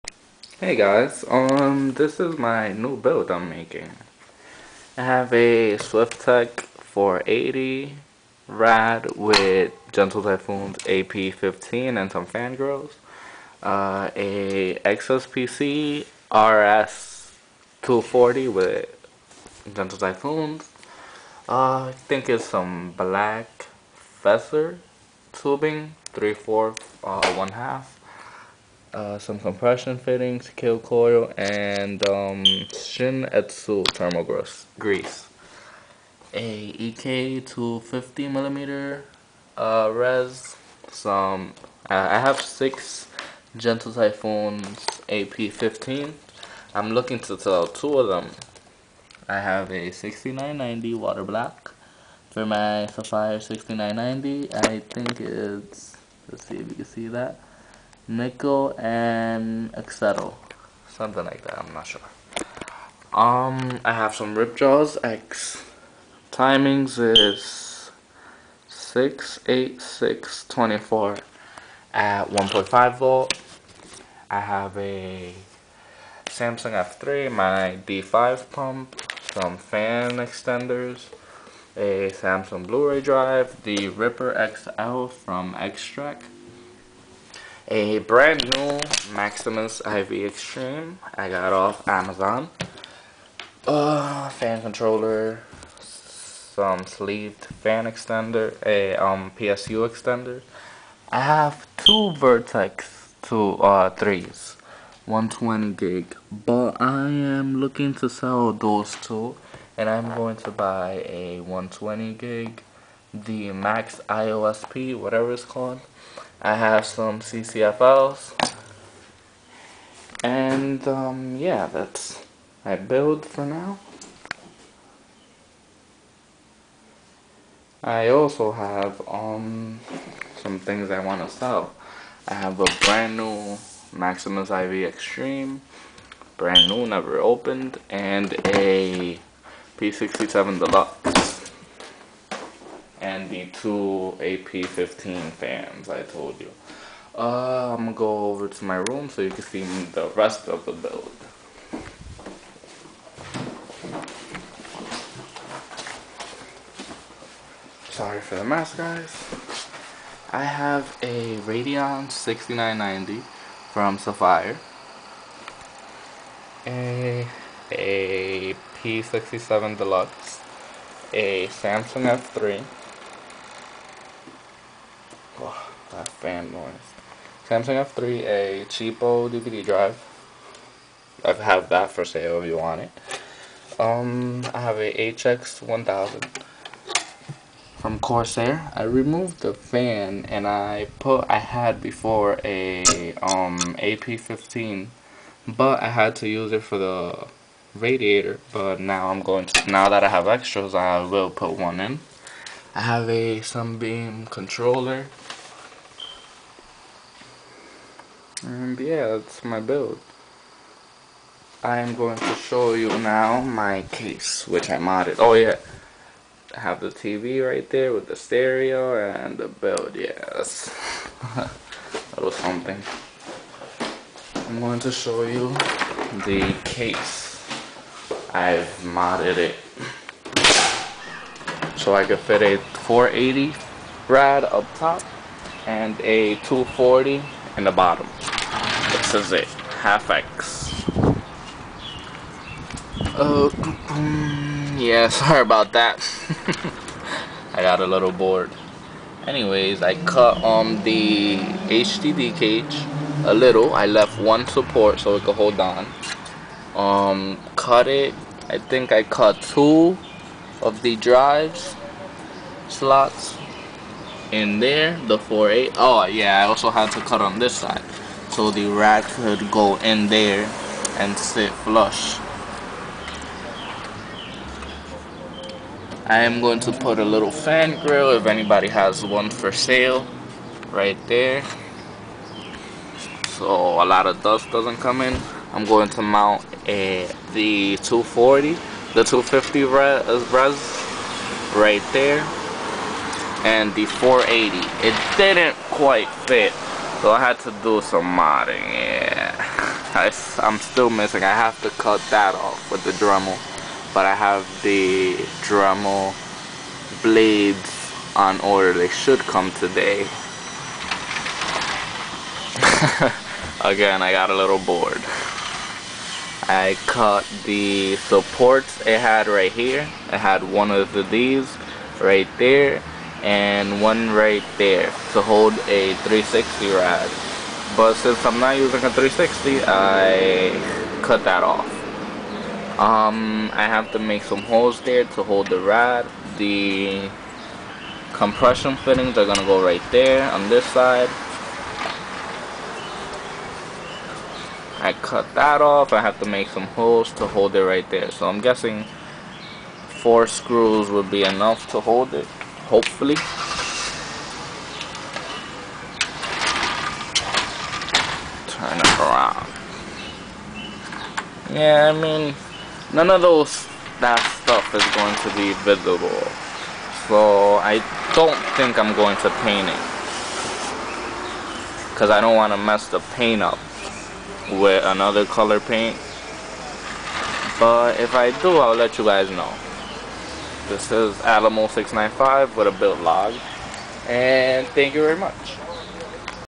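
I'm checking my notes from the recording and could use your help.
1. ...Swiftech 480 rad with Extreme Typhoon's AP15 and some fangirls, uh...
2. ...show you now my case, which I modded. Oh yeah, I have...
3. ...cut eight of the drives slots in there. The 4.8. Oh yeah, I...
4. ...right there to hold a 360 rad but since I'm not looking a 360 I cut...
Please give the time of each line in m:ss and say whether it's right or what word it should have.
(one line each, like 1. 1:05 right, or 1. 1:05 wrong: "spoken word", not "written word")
1. 0:05 wrong: "Gentle", not "Extreme"
2. 3:32 right
3. 4:19 wrong: "two", not "eight"
4. 5:24 wrong: "using", not "looking".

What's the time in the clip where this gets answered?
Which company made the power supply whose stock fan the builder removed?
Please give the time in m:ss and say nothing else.
3:07.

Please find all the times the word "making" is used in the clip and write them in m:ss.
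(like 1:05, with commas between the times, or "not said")
0:03.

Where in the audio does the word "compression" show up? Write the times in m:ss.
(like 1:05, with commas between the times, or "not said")
0:29, 5:38.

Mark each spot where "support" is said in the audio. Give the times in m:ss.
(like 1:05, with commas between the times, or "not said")
4:14, 5:17.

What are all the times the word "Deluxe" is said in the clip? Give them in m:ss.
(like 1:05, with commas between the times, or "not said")
2:20, 2:49.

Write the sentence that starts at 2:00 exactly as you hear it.
And um, yeah, that's my build for now.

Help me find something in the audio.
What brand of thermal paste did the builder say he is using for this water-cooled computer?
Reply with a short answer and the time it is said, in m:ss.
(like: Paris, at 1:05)
Shin Etsu, at 0:32.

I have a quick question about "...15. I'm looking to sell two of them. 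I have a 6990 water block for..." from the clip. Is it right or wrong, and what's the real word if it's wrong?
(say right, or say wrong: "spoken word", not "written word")
right.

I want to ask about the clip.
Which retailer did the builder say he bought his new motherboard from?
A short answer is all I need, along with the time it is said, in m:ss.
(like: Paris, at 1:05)
Amazon, at 1:31.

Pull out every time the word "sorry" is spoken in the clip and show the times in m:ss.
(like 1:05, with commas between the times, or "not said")
2:37, 4:05.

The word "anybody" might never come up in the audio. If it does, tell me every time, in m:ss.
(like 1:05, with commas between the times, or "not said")
4:38.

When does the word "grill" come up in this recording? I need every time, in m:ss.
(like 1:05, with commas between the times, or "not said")
4:37.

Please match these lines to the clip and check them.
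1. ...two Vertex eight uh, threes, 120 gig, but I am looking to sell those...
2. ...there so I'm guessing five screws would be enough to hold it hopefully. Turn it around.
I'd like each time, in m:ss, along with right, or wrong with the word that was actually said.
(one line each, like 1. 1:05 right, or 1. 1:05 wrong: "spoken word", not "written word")
1. 1:41 wrong: "two", not "eight"
2. 5:47 wrong: "four", not "five".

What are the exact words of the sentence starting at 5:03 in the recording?
But I have the Dremel blades on order, they should come today.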